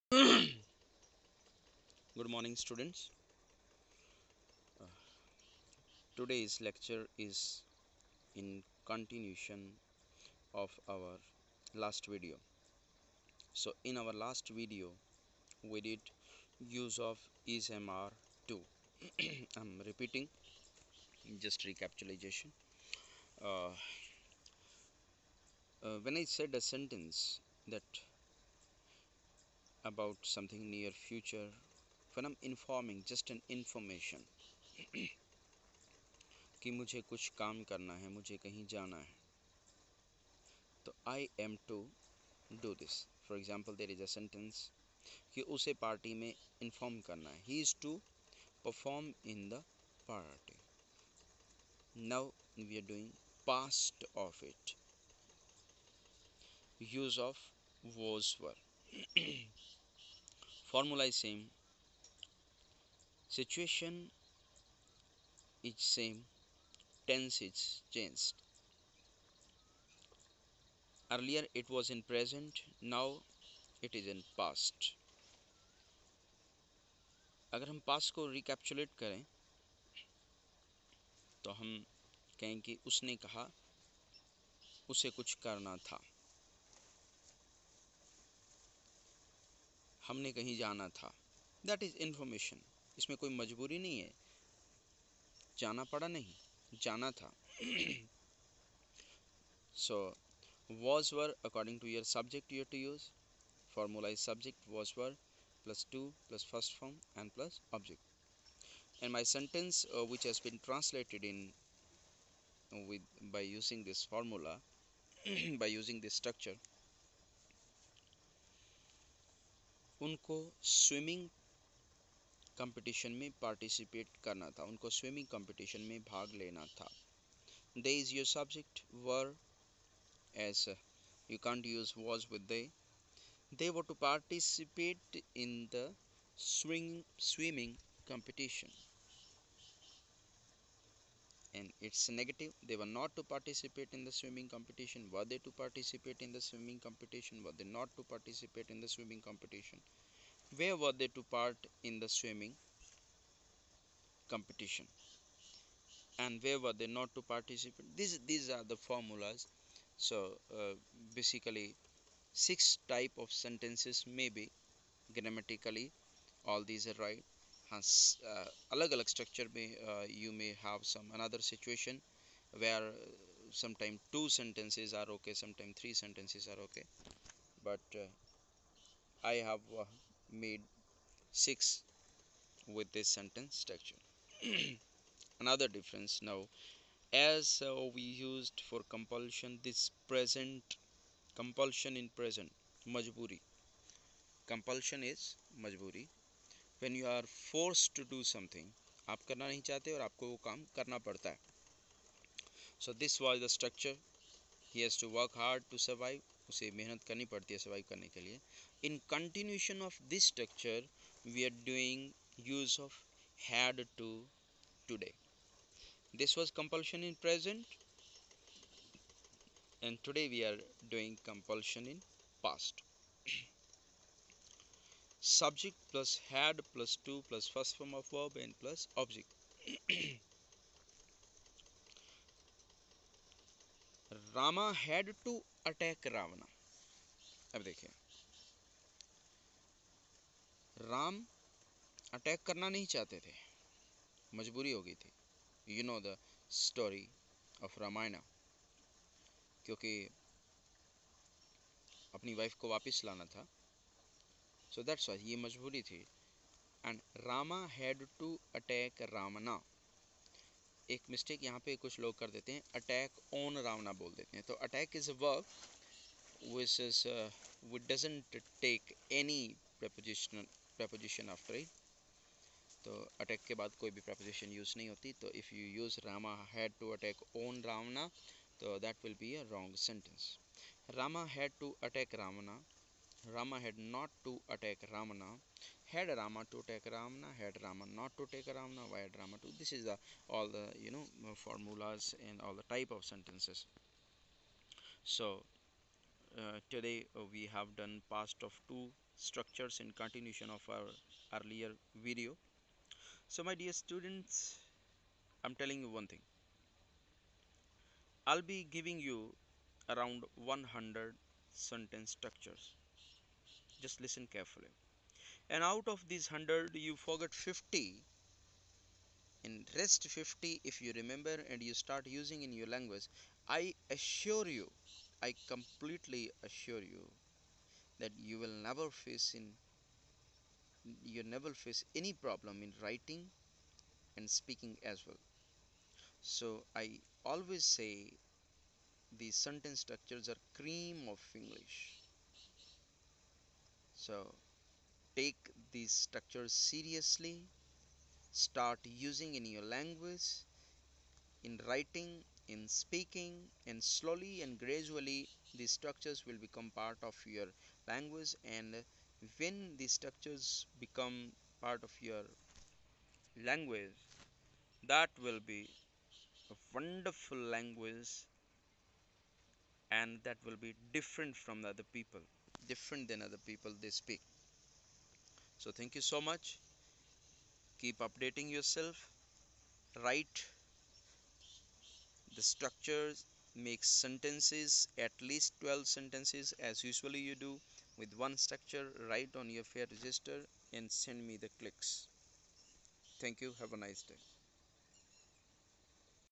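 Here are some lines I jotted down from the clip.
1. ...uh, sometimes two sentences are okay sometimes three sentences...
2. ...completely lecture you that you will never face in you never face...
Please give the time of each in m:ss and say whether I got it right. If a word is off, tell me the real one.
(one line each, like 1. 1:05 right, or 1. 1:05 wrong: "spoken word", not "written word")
1. 2:53 right
2. 5:25 wrong: "assure", not "lecture".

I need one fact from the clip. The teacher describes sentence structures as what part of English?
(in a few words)
cream.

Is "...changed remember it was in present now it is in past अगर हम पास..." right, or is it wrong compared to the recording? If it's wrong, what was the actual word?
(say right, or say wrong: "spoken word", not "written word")
wrong: "earlier", not "remember".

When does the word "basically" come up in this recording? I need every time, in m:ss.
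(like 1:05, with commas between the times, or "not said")
2:41.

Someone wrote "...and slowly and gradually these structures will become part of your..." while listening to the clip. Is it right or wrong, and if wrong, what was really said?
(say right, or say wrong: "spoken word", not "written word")
right.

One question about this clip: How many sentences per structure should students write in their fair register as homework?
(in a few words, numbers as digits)
12.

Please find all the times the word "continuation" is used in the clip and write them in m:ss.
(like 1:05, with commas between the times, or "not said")
0:08, 3:29, 4:59.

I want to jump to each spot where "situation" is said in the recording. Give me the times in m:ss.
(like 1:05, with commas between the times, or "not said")
1:03, 2:51.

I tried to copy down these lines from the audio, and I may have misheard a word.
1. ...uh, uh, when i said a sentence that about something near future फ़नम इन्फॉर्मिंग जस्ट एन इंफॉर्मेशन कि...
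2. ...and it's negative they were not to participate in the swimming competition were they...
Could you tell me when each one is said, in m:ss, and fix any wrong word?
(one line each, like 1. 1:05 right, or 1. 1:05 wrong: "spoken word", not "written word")
1. 0:23 right
2. 2:21 right.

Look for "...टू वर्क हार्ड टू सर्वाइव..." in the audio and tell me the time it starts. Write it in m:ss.
3:25.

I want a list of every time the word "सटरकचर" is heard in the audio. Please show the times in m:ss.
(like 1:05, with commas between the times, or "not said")
1:56, 3:23.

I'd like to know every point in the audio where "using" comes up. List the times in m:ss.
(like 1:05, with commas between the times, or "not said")
5:22, 5:48.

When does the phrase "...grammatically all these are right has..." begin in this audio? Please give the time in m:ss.
2:45.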